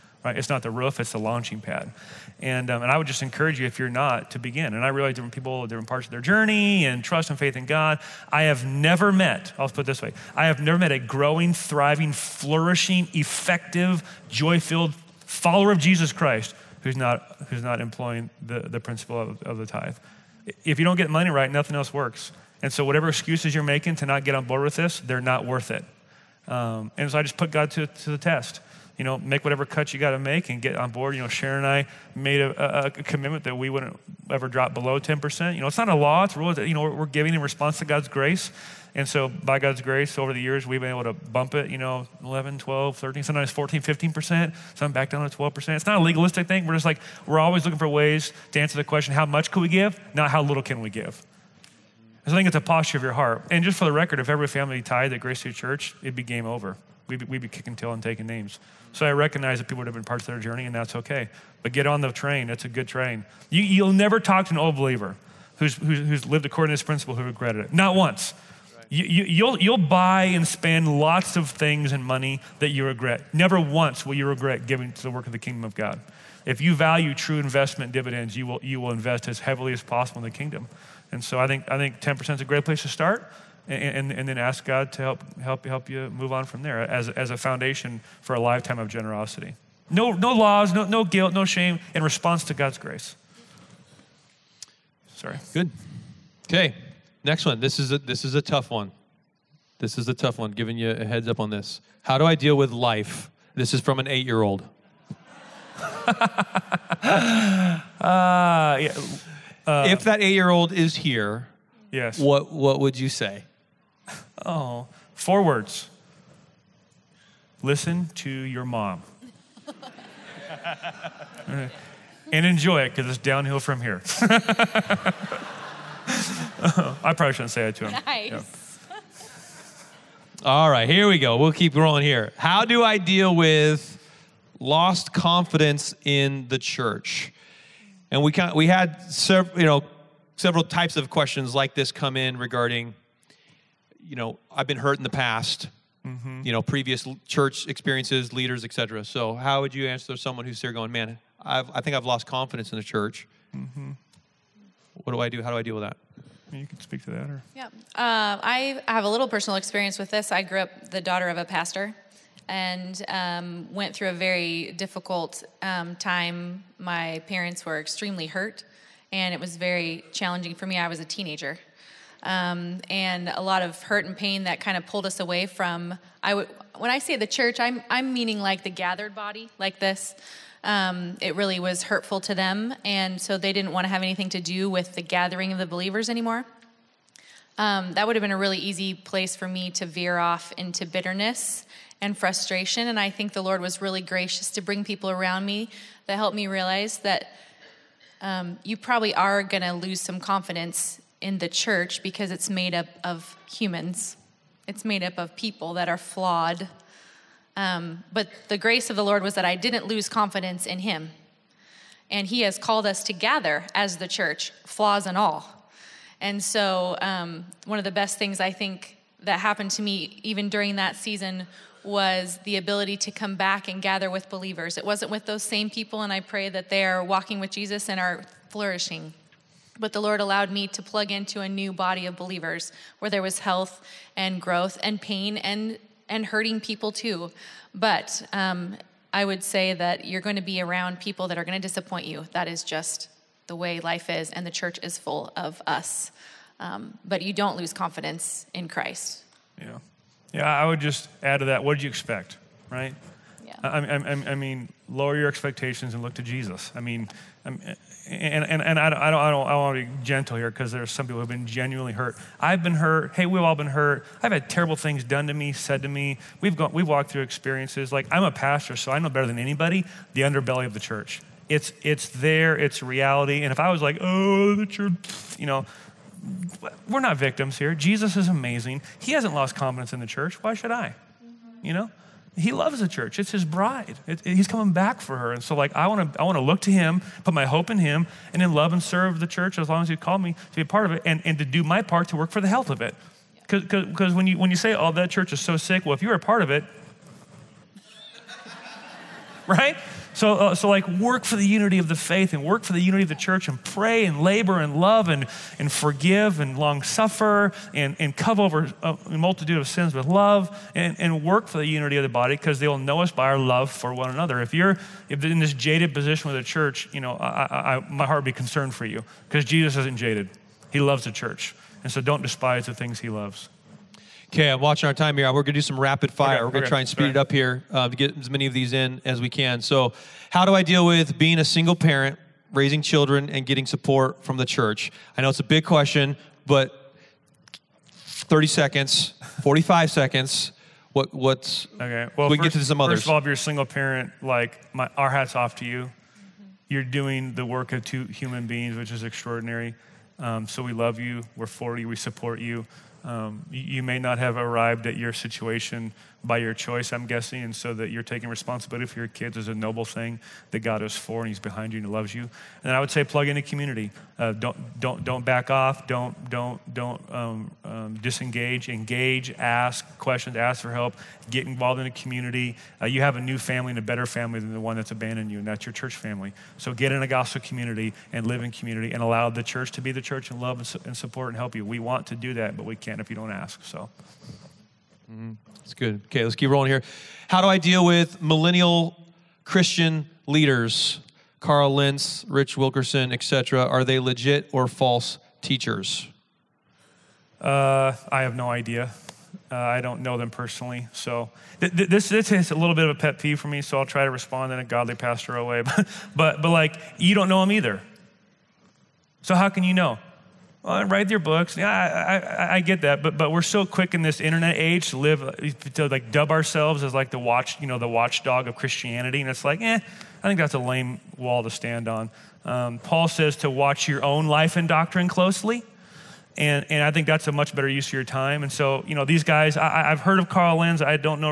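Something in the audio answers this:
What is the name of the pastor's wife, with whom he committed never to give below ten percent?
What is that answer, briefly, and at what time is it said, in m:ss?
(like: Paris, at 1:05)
Sharon, at 0:31.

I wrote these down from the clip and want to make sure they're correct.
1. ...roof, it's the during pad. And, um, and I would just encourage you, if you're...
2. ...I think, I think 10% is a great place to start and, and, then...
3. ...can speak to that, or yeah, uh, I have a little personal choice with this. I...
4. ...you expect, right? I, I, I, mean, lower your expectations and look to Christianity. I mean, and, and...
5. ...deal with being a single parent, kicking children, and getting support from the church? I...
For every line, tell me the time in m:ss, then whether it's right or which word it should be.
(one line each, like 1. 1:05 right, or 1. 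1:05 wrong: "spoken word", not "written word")
1. 0:00 wrong: "launching", not "during"
2. 1:21 right
3. 2:36 wrong: "experience", not "choice"
4. 4:11 wrong: "Jesus", not "Christianity"
5. 5:30 wrong: "raising", not "kicking".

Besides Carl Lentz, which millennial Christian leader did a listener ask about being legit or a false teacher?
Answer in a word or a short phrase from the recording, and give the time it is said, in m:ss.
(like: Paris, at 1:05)
Rich Wilkerson, at 6:32.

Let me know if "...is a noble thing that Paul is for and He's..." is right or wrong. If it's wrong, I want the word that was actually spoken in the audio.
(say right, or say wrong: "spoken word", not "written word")
wrong: "God", not "Paul".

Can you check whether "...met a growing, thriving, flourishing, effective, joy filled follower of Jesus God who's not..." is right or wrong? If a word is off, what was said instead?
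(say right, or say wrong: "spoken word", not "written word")
wrong: "Christ", not "God".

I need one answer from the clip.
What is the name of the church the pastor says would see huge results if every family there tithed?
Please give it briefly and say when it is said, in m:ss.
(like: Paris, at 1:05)
Grace City Church, at 0:55.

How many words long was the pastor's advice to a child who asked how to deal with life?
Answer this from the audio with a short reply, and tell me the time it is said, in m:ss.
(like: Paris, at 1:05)
4, at 1:55.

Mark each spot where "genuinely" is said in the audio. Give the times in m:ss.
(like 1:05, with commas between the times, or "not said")
4:21.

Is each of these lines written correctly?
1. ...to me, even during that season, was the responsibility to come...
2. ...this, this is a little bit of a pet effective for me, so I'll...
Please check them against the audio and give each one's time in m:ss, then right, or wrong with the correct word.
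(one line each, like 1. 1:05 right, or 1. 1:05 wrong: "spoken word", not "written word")
1. 3:39 wrong: "ability", not "responsibility"
2. 6:41 wrong: "peeve", not "effective".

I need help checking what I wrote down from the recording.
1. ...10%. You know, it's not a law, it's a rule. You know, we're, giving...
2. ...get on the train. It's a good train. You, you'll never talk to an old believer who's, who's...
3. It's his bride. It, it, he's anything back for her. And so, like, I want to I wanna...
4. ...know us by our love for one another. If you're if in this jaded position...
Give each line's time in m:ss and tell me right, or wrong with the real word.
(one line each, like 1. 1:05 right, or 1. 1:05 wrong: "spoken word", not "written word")
1. 0:34 right
2. 1:01 right
3. 4:43 wrong: "coming", not "anything"
4. 5:12 right.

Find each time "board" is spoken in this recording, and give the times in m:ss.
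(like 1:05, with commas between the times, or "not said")
0:24, 0:30.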